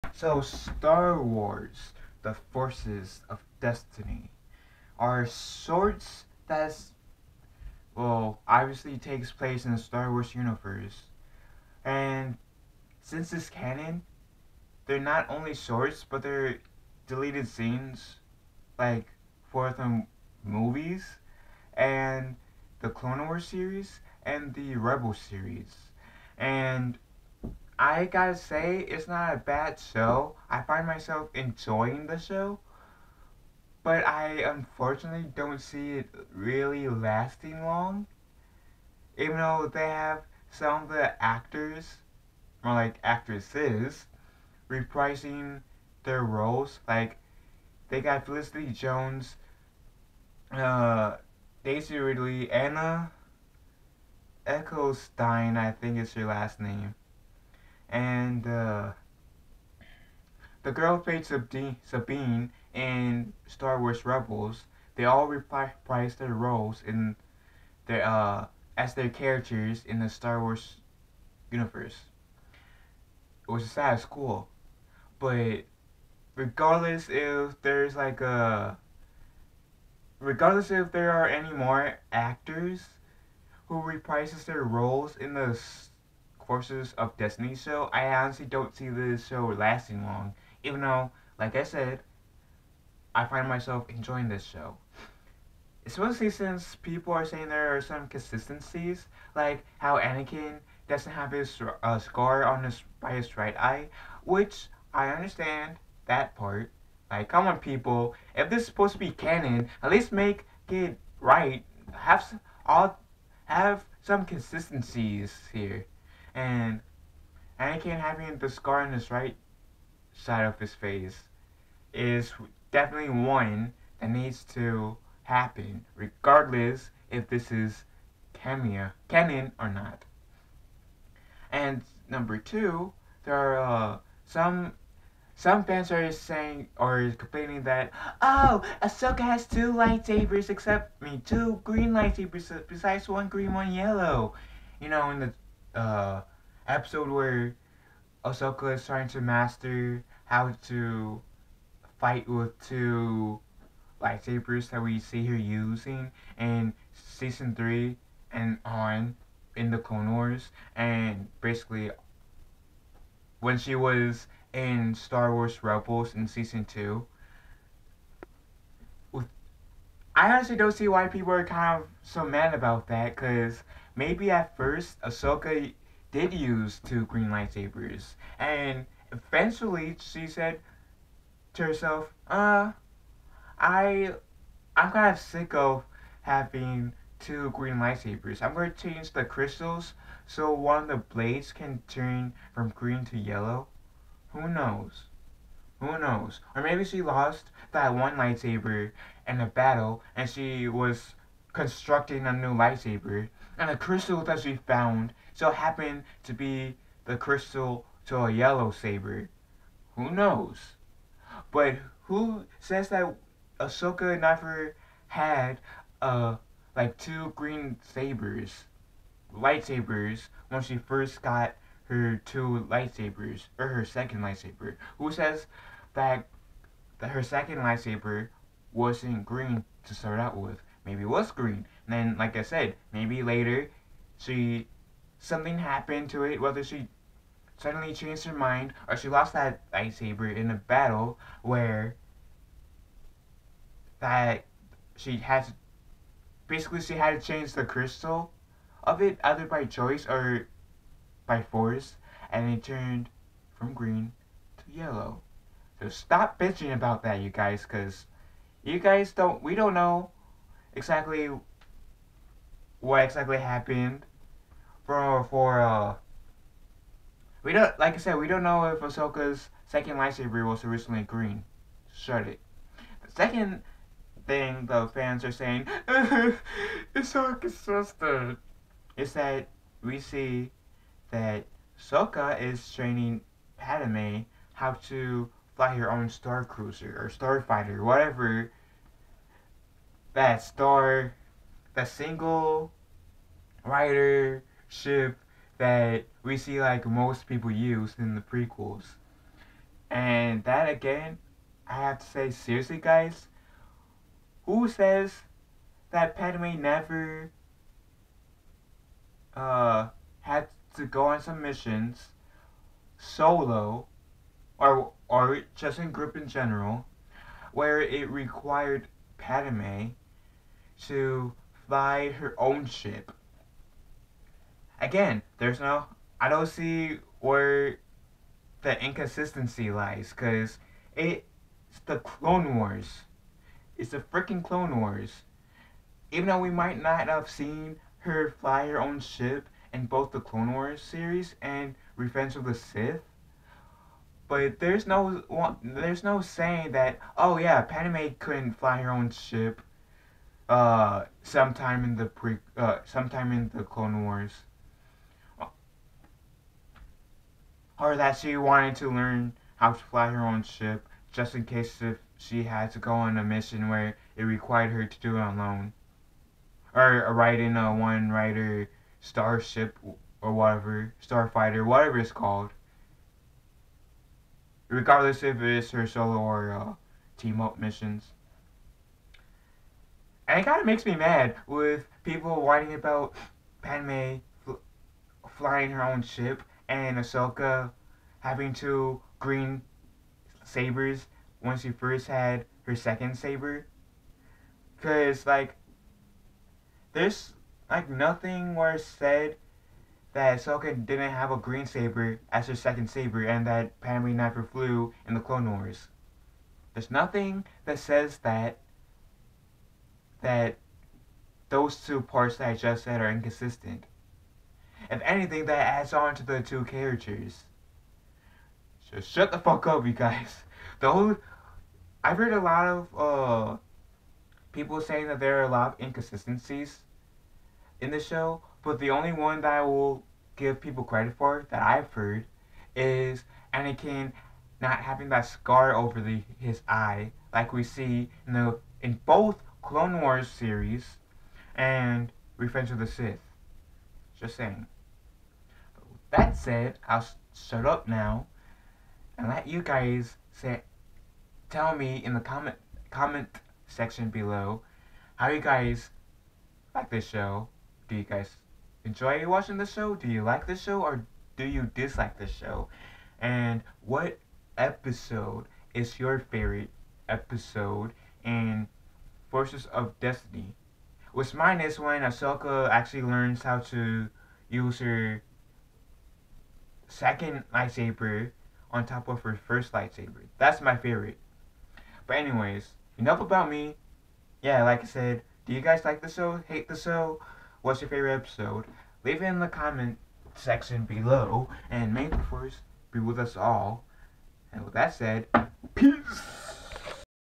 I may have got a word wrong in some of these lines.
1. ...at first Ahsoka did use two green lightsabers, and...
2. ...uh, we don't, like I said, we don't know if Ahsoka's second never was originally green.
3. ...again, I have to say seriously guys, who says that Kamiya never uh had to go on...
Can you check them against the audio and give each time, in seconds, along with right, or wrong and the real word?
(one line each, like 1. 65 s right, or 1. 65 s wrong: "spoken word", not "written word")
1. 174 s right
2. 265 s wrong: "lightsaber", not "never"
3. 300 s wrong: "Padme", not "Kamiya".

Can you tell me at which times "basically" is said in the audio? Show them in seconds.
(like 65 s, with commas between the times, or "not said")
161 s, 246 s.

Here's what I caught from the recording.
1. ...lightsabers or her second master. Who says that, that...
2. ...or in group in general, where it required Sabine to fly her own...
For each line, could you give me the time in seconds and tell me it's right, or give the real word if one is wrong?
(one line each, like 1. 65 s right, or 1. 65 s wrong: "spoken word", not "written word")
1. 222 s wrong: "lightsaber", not "master"
2. 315 s wrong: "Padme", not "Sabine".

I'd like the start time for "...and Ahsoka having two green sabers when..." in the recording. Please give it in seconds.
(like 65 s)
386 s.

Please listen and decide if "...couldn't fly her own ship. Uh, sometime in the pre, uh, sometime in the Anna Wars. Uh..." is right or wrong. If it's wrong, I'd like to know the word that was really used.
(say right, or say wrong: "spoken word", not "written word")
wrong: "Clone", not "Anna".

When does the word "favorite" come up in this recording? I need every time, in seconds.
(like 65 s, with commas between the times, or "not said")
466 s, 480 s, 487 s.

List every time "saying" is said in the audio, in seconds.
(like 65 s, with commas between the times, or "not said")
97 s, 136 s, 275 s, 346 s, 424 s, 444 s.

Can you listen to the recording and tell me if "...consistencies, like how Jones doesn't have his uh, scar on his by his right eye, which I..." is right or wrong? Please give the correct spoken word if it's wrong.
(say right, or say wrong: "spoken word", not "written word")
wrong: "Anakin", not "Jones".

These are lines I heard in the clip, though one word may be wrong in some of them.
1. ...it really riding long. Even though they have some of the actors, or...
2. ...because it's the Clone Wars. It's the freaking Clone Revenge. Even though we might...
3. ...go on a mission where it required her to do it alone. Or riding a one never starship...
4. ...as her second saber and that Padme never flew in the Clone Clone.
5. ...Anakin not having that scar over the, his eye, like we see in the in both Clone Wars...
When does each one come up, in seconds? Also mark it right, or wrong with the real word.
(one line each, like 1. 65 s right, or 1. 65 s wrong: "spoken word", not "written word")
1. 35 s wrong: "lasting", not "riding"
2. 330 s wrong: "Wars", not "Revenge"
3. 362 s wrong: "rider", not "never"
4. 402 s wrong: "Wars", not "Clone"
5. 433 s right.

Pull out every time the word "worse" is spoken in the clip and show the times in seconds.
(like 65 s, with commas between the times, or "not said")
398 s.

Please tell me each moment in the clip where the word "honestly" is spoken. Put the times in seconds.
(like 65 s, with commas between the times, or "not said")
88 s, 170 s.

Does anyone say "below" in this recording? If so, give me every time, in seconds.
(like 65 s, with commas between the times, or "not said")
454 s, 490 s.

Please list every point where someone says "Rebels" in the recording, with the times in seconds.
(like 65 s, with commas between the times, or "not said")
24 s, 64 s, 165 s.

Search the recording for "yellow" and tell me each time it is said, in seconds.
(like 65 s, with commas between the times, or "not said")
143 s, 193 s, 208 s, 254 s.